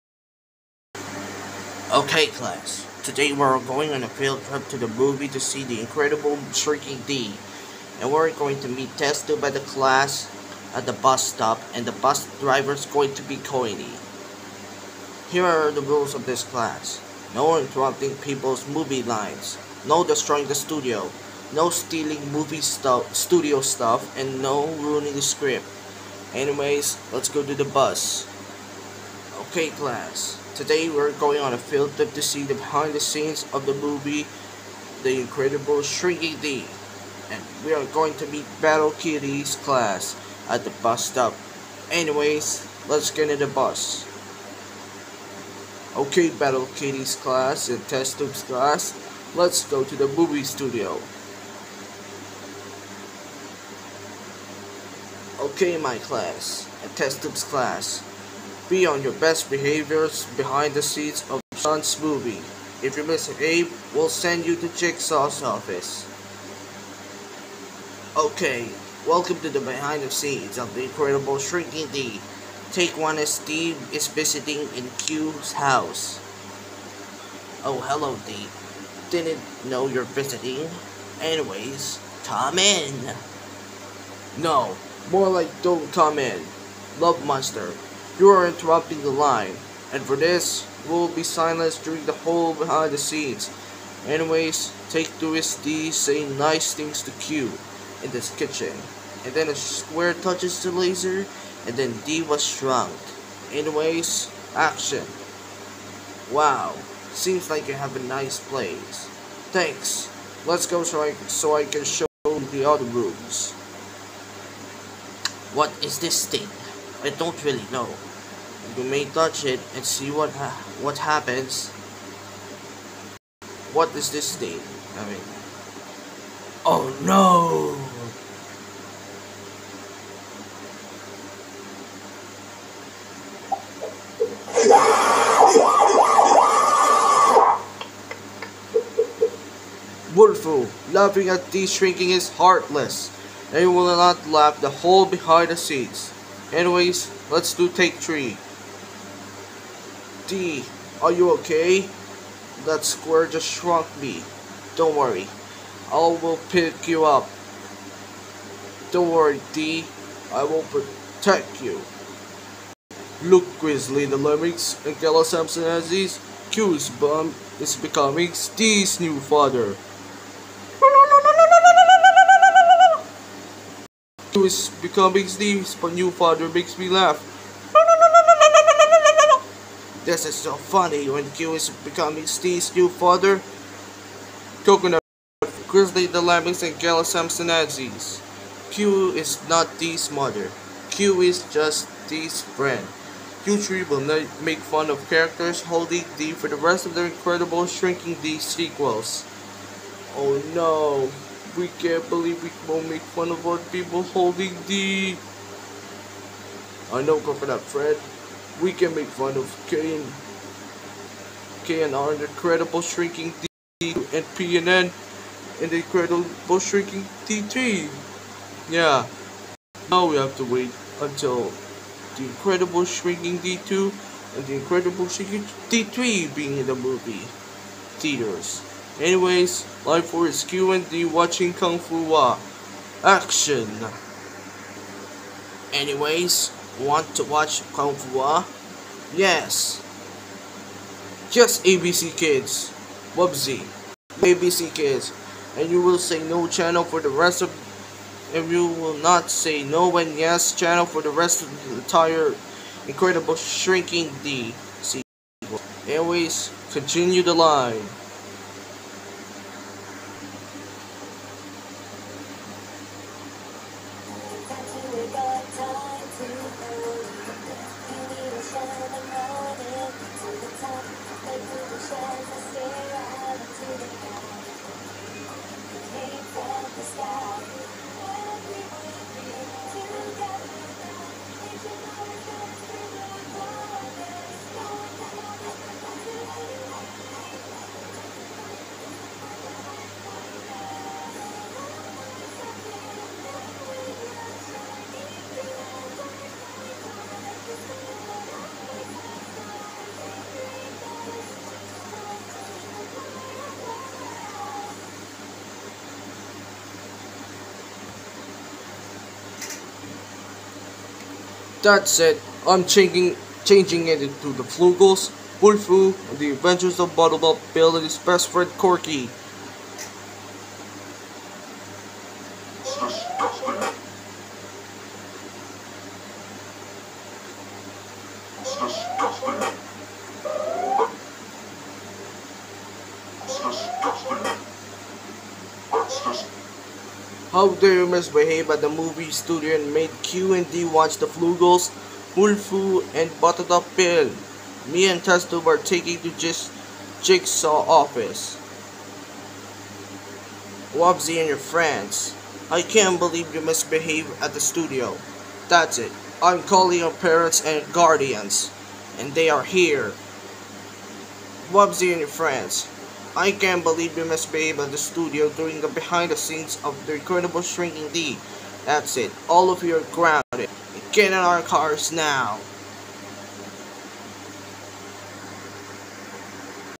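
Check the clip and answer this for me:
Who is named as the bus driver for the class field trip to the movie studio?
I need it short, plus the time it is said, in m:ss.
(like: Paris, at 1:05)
Coiny, at 0:13.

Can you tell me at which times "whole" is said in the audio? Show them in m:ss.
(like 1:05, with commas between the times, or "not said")
1:32, 2:24.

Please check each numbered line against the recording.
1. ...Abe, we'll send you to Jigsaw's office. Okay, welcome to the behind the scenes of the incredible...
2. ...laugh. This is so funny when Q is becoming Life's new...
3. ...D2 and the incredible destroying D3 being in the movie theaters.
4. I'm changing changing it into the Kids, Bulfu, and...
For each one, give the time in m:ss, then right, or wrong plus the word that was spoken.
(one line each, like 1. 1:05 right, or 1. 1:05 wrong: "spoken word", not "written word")
1. 1:03 right
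2. 2:56 wrong: "Steve", not "Life"
3. 3:43 wrong: "shrinking", not "destroying"
4. 5:12 wrong: "Flugels", not "Kids".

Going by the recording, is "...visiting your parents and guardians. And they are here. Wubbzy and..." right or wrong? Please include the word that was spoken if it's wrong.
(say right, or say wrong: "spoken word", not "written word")
wrong: "calling", not "visiting".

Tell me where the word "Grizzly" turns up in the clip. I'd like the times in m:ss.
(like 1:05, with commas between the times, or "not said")
2:43, 3:05.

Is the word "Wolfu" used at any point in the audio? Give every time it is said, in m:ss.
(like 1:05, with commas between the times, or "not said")
2:20, 5:42.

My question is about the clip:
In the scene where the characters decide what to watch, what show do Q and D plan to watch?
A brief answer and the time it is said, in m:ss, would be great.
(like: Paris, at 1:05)
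Kung Fu Wa, at 3:51.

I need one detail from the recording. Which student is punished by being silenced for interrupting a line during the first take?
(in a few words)
Love Monster.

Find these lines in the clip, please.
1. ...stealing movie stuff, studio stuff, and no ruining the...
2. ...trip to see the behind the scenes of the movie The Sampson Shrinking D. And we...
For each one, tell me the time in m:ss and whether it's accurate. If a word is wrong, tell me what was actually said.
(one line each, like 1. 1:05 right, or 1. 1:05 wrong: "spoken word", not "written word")
1. 0:21 right
2. 0:31 wrong: "Incredible", not "Sampson".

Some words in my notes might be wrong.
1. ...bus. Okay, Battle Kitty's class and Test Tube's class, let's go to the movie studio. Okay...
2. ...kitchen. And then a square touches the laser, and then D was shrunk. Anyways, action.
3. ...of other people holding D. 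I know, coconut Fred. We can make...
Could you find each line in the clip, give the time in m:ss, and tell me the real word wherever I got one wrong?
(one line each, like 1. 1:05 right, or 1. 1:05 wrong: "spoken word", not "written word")
1. 0:43 right
2. 1:38 right
3. 3:23 right.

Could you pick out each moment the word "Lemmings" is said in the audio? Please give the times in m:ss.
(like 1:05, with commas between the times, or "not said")
2:44, 3:06.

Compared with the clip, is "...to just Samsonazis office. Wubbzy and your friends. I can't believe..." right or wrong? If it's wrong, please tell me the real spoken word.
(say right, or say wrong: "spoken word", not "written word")
wrong: "Jigsaw", not "Samsonazis".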